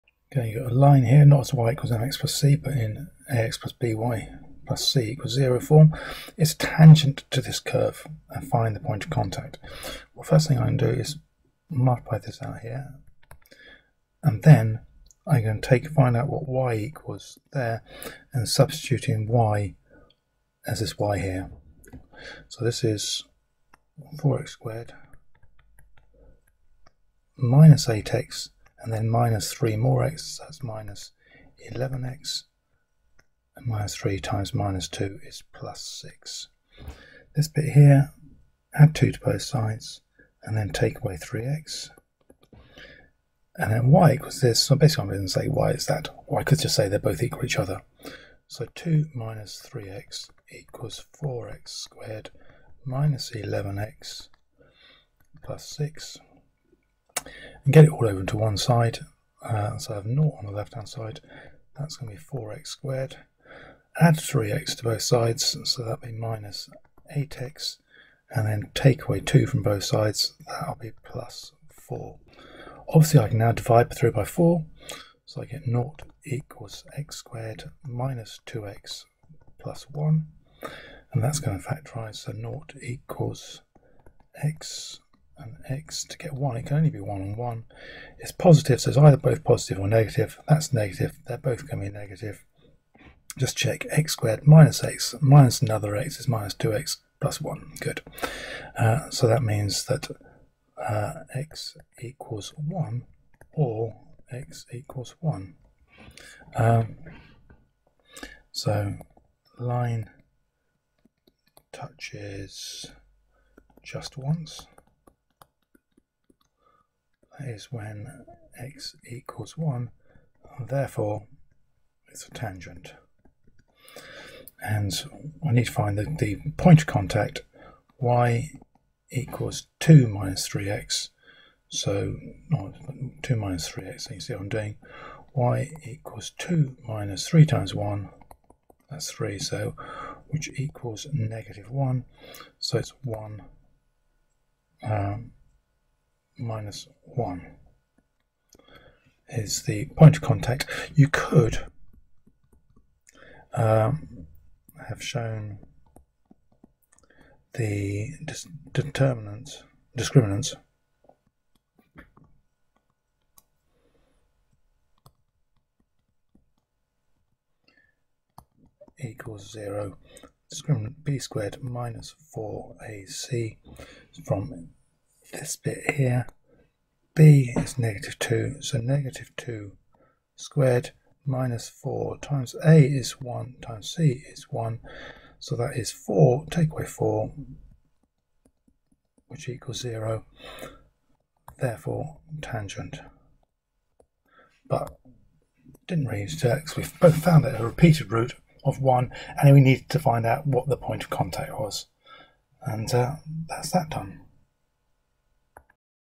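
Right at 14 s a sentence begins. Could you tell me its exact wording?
And then I'm going to take find out what y equals there and substitute in y as this y here.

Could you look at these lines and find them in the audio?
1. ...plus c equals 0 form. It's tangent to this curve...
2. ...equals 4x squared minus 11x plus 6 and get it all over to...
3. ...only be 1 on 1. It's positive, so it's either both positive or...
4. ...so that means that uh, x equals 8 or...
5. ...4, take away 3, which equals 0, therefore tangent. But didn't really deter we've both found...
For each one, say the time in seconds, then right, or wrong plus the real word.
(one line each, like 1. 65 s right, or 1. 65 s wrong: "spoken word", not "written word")
1. 4 s right
2. 50 s right
3. 86 s right
4. 99 s wrong: "1", not "8"
5. 185 s wrong: "4", not "3".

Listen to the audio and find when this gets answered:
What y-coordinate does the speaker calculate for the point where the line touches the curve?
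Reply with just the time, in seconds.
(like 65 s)
141 s.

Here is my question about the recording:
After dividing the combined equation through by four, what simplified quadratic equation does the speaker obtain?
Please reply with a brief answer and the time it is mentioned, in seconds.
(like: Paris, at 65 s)
0 = x^2 - 2x + 1, at 75 s.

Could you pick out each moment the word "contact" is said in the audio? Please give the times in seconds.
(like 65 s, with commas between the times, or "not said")
9 s, 126 s, 150 s, 201 s.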